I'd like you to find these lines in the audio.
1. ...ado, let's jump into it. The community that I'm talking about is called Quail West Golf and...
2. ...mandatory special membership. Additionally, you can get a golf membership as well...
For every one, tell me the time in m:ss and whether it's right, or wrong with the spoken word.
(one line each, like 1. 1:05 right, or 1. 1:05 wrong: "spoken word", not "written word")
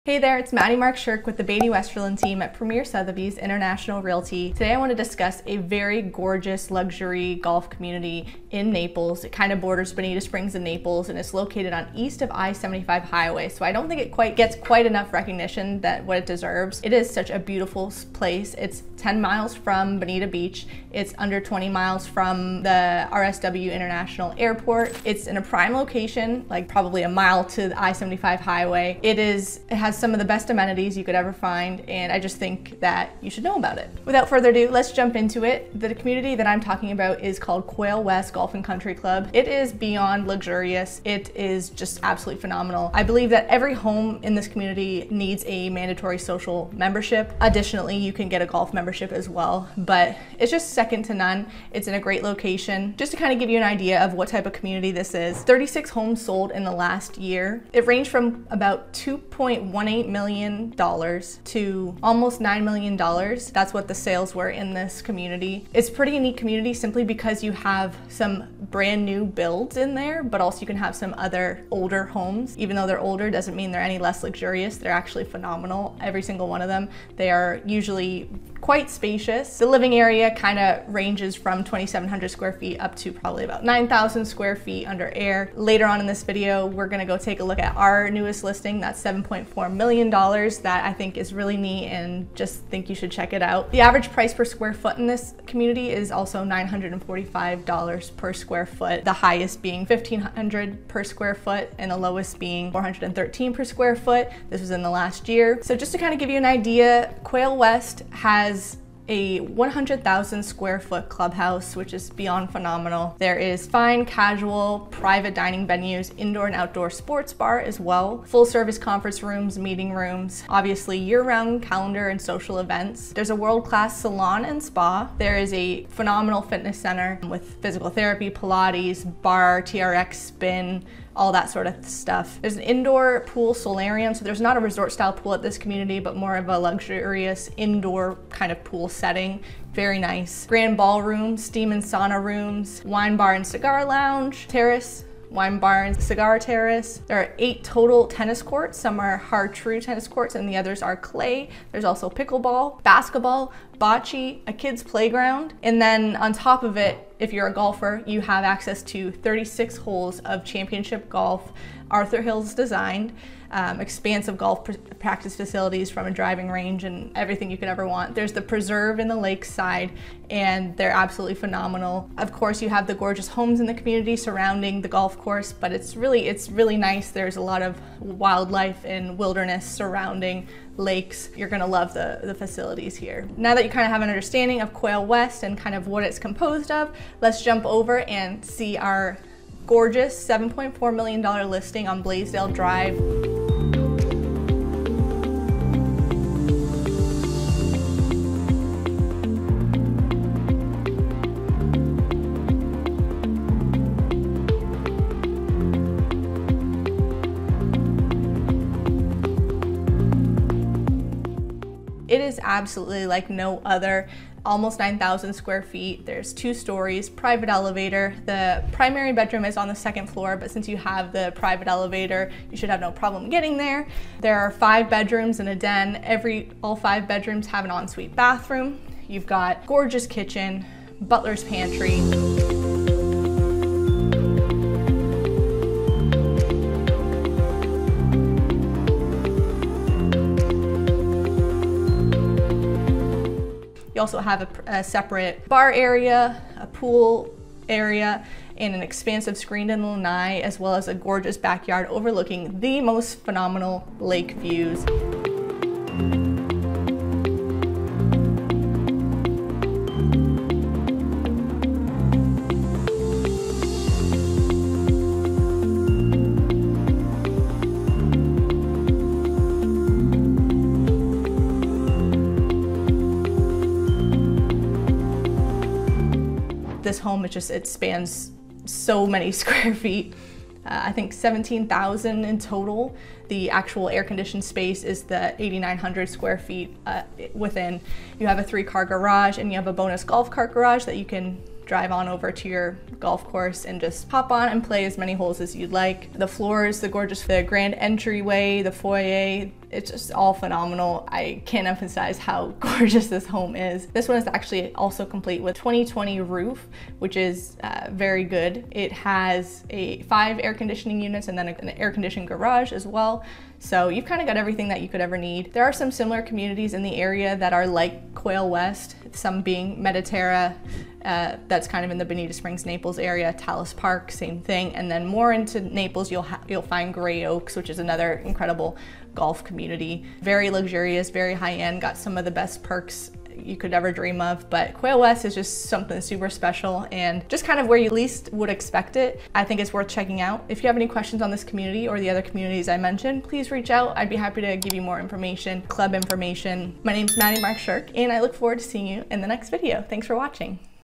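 1. 0:34 right
2. 0:45 wrong: "social", not "special".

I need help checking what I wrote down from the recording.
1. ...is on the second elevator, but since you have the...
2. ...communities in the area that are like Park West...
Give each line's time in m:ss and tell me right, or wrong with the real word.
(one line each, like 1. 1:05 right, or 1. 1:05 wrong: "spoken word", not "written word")
1. 3:39 wrong: "floor", not "elevator"
2. 5:16 wrong: "Quail", not "Park".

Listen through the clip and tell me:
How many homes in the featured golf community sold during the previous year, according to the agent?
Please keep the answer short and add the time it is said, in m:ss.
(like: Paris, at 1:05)
36, at 0:55.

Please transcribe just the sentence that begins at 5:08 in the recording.
It has a five air conditioning units and then an air conditioned garage as well.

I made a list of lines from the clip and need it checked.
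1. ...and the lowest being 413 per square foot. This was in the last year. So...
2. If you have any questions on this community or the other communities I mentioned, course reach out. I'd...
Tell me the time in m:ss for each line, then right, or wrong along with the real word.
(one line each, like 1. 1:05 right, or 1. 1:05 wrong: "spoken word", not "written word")
1. 1:41 right
2. 5:40 wrong: "please", not "course".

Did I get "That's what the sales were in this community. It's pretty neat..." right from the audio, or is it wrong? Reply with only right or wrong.
right.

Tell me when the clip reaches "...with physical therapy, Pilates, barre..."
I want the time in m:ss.
2:07.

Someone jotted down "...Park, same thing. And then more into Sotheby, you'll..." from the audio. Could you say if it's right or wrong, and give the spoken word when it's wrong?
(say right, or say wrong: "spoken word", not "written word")
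wrong: "Naples", not "Sotheby".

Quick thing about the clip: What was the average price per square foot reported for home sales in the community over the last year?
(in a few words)
$945.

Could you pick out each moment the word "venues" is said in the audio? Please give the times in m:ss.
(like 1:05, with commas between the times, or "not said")
1:55.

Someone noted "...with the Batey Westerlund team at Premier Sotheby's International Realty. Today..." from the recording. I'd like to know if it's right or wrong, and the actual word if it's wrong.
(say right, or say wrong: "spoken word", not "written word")
right.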